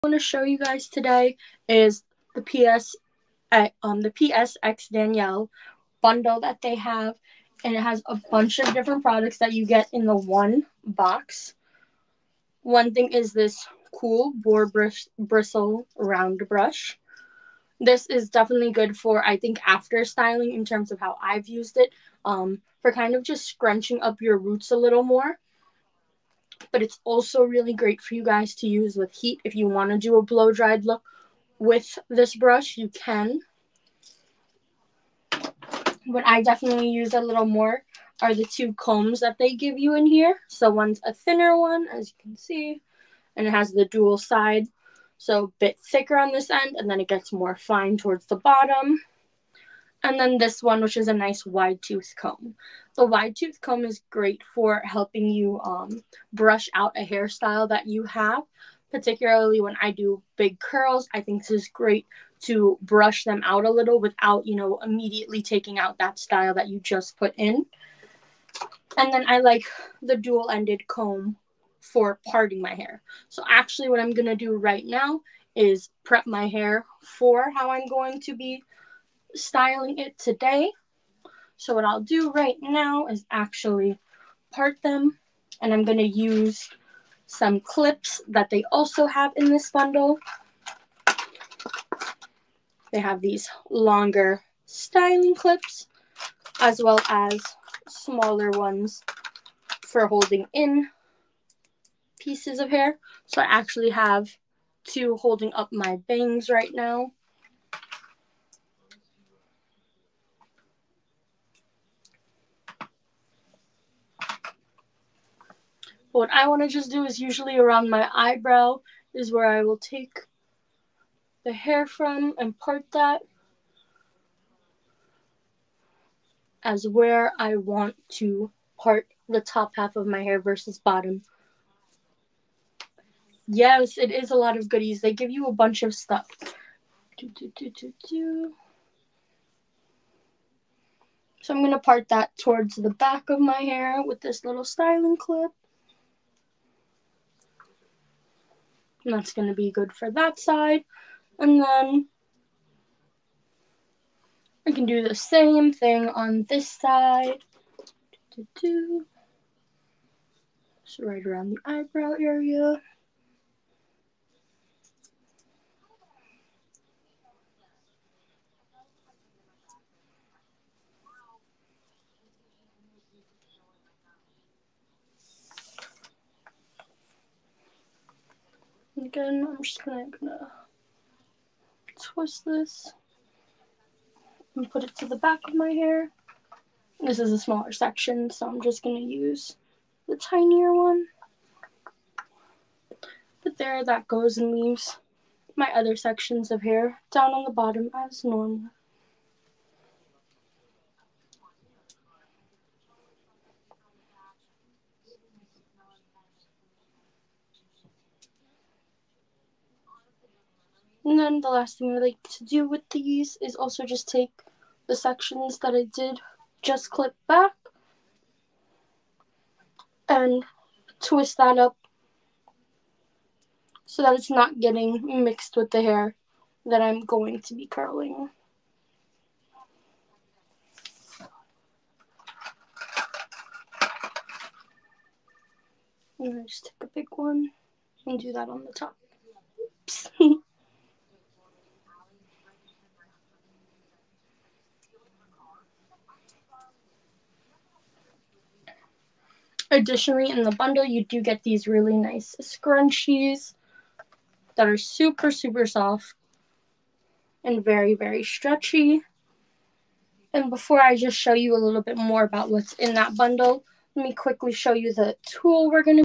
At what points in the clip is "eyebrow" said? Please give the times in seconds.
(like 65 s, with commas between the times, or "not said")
118 s, 161 s.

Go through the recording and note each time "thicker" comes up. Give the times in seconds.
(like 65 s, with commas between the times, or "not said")
45 s.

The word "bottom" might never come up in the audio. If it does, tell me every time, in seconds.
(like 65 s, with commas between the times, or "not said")
48 s, 130 s, 197 s.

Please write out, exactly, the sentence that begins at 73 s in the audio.
So actually what I'm going to do right now is prep my hair for how I'm going to be styling it today.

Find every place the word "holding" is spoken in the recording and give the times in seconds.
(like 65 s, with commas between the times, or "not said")
100 s, 105 s.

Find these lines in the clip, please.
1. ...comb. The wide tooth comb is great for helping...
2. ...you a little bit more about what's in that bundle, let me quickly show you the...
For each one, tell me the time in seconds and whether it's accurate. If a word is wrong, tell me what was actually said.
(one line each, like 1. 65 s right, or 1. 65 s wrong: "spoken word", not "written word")
1. 52 s right
2. 261 s right.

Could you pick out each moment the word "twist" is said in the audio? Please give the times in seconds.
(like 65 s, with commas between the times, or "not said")
181 s, 220 s.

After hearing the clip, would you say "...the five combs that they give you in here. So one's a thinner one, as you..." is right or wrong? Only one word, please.
wrong.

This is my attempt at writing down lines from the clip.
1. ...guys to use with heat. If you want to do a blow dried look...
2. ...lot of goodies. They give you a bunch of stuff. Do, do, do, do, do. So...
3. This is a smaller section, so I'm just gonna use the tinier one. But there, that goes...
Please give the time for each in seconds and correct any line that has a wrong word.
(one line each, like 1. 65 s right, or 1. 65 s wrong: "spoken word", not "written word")
1. 28 s right
2. 134 s right
3. 186 s right.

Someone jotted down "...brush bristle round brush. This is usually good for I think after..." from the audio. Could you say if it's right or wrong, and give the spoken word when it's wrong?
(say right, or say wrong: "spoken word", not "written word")
wrong: "definitely", not "usually".